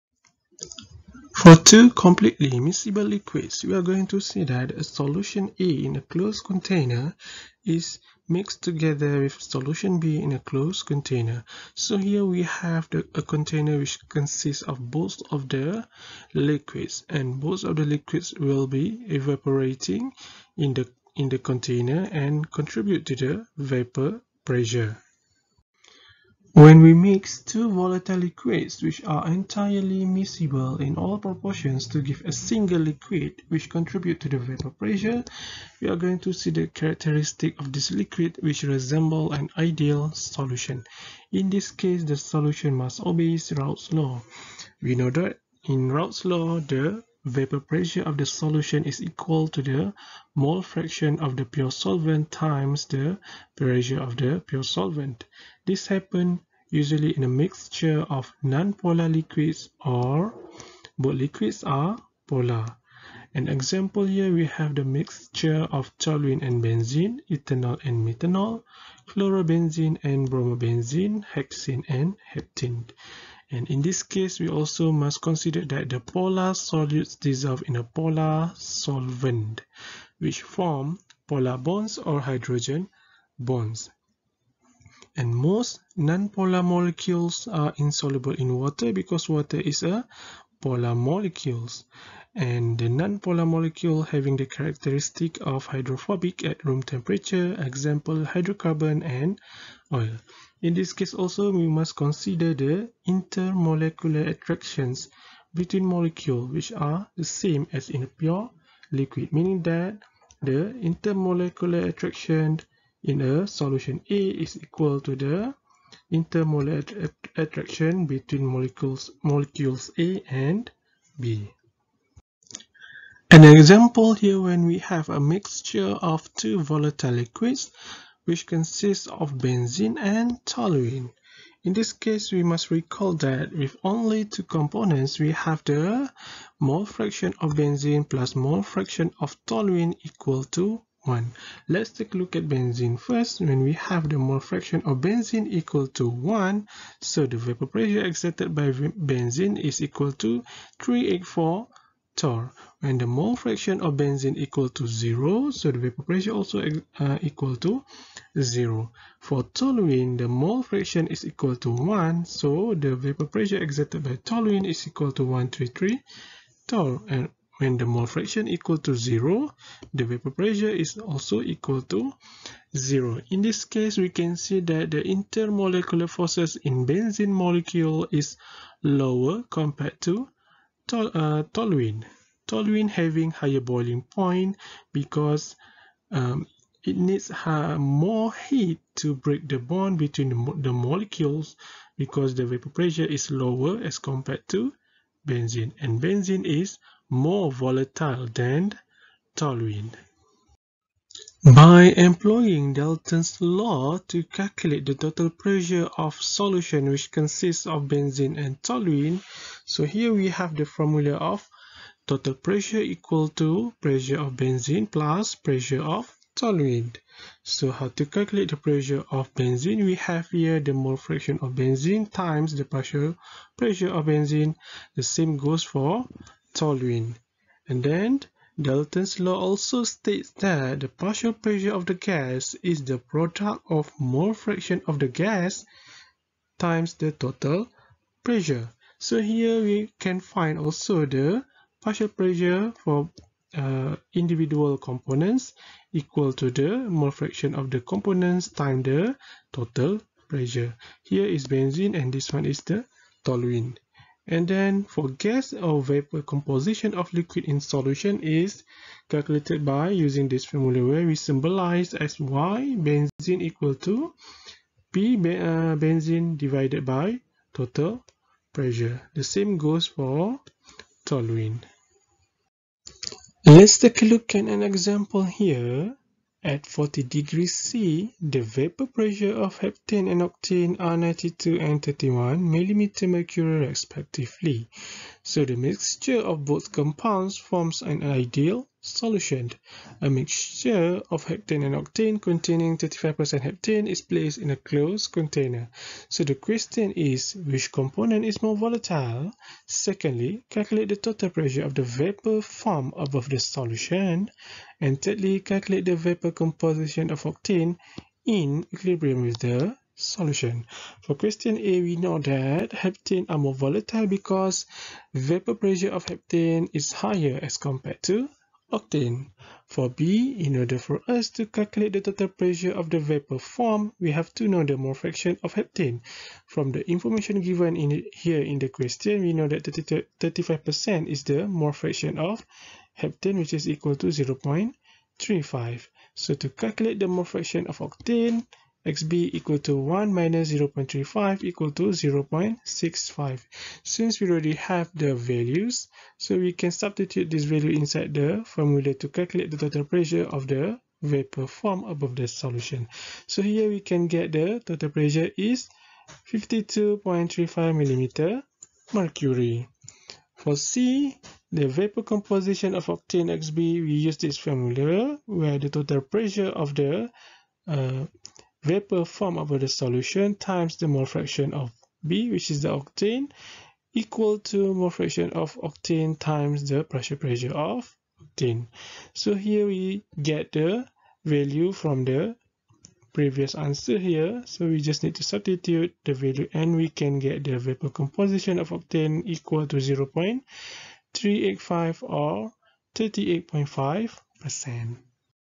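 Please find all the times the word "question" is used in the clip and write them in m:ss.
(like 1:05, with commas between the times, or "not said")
4:56, 5:11, 5:28.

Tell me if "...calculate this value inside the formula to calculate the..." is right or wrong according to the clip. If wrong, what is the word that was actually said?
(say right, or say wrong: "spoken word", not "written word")
wrong: "substitute", not "calculate".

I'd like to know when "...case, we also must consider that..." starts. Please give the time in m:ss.
1:14.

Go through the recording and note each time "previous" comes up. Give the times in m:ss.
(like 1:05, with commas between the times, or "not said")
6:23.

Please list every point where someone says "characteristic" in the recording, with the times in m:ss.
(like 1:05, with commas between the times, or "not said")
0:36, 1:34.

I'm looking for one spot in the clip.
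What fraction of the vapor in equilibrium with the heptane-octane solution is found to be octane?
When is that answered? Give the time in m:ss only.
6:29.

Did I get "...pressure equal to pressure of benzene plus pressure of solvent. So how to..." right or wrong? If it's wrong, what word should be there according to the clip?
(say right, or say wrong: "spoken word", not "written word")
right.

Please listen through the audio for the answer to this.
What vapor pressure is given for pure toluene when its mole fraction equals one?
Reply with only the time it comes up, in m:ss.
2:45.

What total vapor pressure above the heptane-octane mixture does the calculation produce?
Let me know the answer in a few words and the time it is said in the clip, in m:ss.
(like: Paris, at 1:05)
52.35 mmHg, at 5:56.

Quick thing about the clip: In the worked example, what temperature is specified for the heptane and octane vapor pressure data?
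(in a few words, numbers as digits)
40 degrees C.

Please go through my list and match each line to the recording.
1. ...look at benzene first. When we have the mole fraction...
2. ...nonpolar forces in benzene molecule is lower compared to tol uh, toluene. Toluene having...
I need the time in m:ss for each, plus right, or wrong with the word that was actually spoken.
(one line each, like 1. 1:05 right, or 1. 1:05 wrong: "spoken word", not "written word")
1. 2:22 right
2. 2:55 wrong: "intermolecular", not "nonpolar".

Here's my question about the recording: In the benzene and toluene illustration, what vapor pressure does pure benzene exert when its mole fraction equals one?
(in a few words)
384 torr.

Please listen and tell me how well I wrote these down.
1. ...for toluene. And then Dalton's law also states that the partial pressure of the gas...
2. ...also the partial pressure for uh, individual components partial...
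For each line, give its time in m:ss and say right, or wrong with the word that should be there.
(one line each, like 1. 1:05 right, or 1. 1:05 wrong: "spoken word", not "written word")
1. 3:45 right
2. 4:00 wrong: "equal", not "partial".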